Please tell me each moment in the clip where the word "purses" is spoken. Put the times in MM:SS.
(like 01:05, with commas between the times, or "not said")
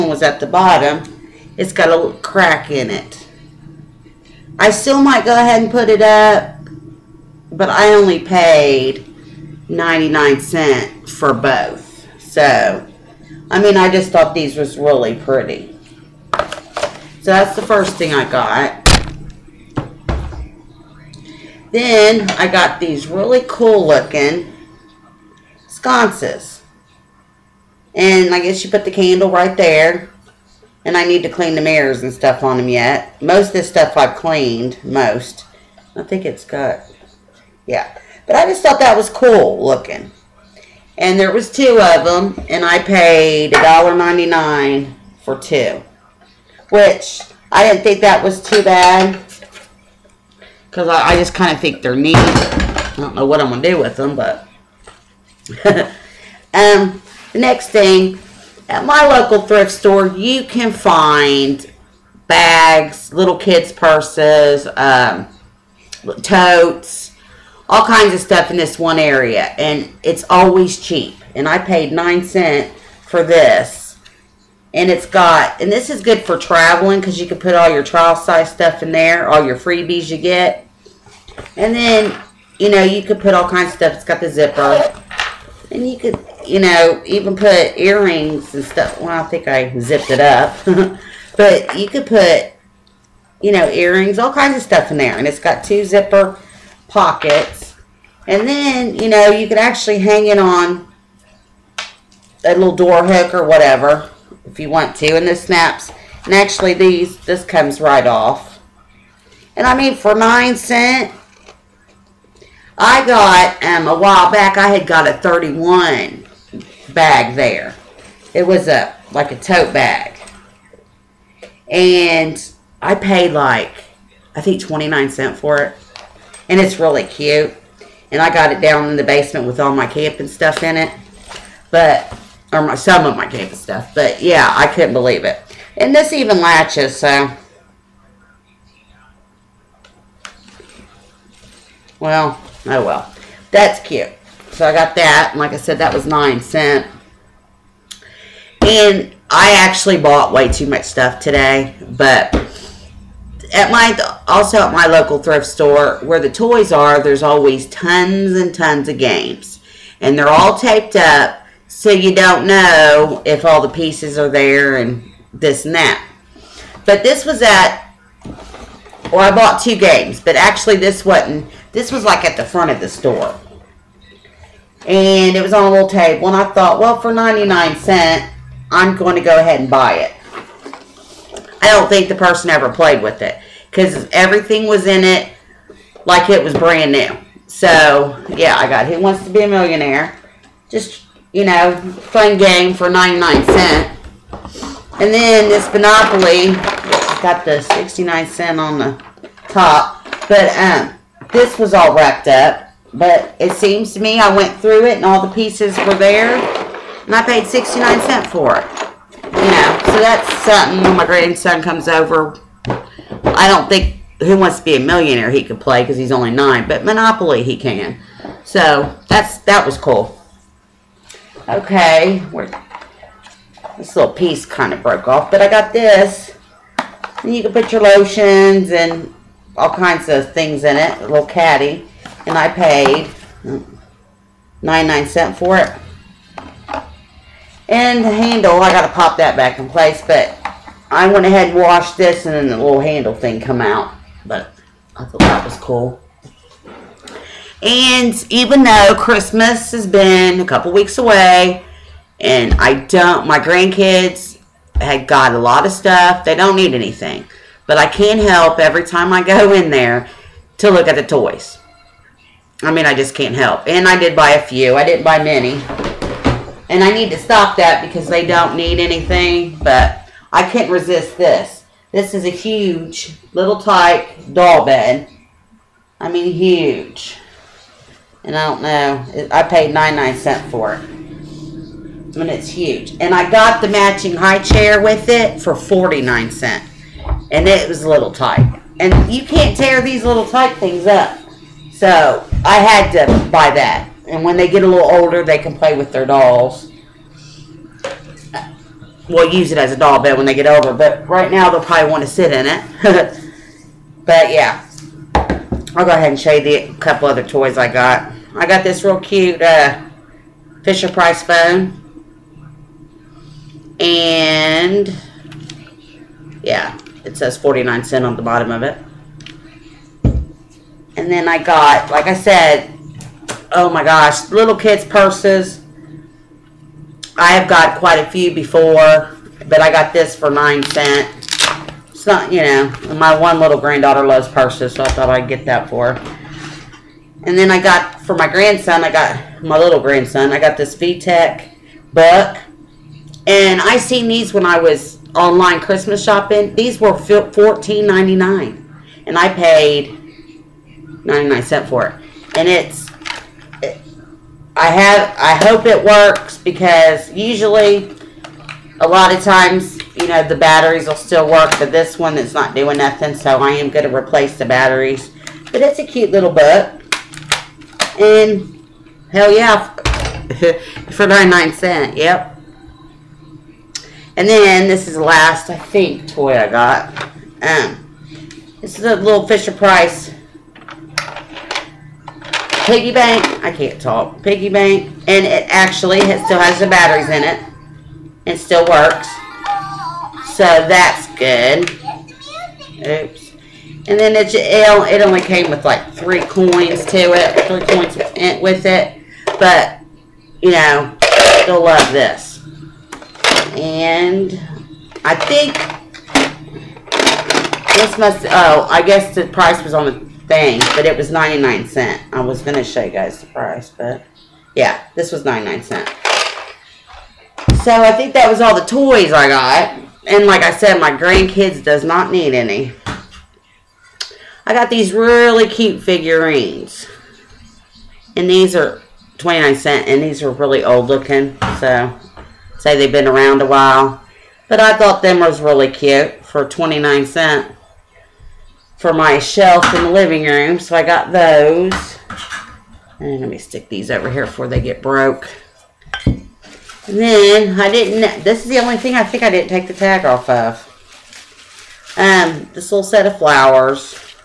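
01:03, 05:24, 05:34.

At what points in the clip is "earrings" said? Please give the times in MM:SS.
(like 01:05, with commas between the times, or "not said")
01:27, 01:33.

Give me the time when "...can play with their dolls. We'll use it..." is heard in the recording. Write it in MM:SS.
04:55.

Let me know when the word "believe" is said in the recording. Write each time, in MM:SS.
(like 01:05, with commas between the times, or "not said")
02:14.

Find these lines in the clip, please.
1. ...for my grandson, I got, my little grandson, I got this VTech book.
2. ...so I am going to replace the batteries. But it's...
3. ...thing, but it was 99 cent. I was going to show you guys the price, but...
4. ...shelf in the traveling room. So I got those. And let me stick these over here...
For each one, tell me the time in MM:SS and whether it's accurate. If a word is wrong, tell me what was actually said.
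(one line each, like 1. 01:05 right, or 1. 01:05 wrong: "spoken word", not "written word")
1. 05:38 right
2. 06:03 right
3. 06:50 right
4. 07:19 wrong: "living", not "traveling".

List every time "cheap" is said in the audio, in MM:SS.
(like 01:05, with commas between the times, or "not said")
01:10.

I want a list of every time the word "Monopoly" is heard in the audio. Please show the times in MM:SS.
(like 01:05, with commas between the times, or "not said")
03:15, 03:36.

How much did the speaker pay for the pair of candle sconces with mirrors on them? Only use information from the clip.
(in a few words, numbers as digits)
$1.99.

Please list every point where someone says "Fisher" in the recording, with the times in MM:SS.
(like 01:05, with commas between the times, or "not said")
05:10, 06:19.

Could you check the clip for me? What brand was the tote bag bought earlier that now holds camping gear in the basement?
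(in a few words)
Thirty-one.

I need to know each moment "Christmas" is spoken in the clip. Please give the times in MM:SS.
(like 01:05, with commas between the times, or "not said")
04:08, 05:45.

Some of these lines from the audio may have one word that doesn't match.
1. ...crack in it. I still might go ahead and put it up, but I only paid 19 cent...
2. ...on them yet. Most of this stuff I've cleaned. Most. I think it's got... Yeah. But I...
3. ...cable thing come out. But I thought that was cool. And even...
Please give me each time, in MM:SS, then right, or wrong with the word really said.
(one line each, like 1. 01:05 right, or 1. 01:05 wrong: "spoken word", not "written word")
1. 00:02 wrong: "99", not "19"
2. 00:32 right
3. 04:02 wrong: "handle", not "cable".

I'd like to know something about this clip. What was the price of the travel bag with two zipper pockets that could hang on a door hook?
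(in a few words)
9 cents.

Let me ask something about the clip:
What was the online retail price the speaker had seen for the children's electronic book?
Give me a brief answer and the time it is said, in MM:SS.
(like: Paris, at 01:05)
$14.99, at 05:46.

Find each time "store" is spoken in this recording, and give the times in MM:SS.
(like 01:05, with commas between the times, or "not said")
00:59, 02:35, 02:52.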